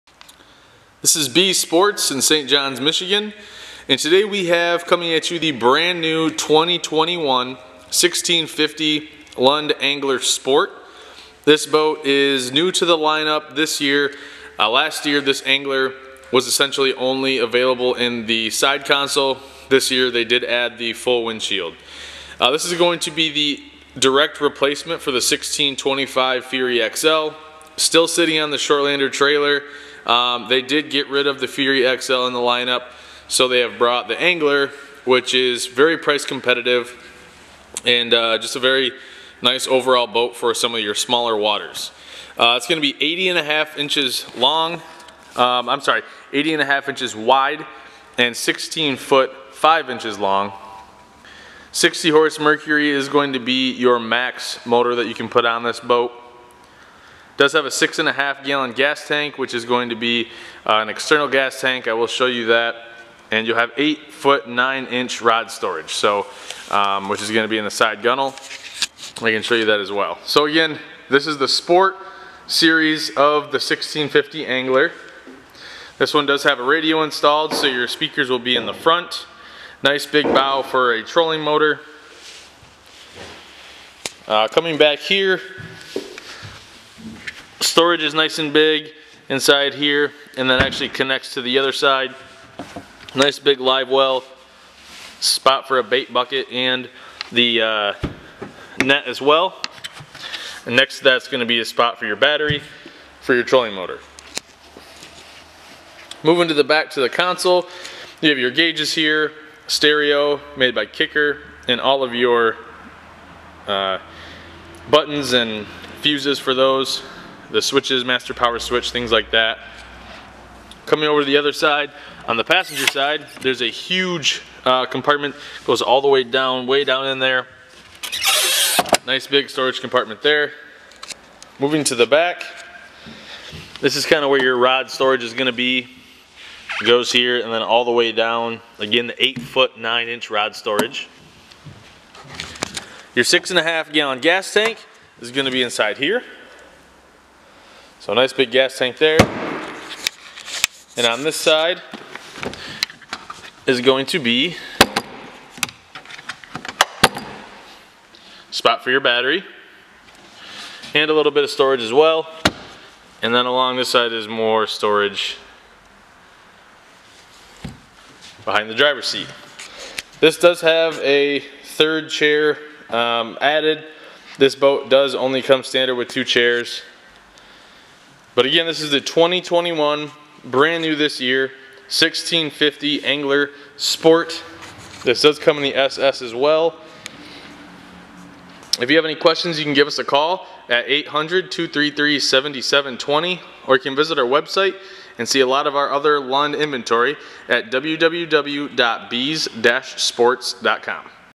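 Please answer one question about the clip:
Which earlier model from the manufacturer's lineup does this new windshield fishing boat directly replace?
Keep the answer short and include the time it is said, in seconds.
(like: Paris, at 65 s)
1625 Fury XL, at 25 s.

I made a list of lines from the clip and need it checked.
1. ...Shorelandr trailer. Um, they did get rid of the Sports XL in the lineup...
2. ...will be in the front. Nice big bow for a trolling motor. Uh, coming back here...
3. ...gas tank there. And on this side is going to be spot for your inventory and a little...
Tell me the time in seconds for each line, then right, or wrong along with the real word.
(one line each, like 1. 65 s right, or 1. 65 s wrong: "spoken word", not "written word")
1. 28 s wrong: "Fury", not "Sports"
2. 78 s right
3. 148 s wrong: "battery", not "inventory".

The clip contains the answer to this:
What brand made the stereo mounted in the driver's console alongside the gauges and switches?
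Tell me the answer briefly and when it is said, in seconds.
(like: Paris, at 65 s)
Kicker, at 110 s.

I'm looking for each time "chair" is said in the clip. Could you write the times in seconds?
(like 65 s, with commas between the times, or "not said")
172 s, 176 s.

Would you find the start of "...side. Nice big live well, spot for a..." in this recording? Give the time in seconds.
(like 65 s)
91 s.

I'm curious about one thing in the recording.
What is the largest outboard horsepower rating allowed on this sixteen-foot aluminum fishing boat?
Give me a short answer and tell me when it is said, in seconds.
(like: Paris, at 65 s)
60 horse, at 51 s.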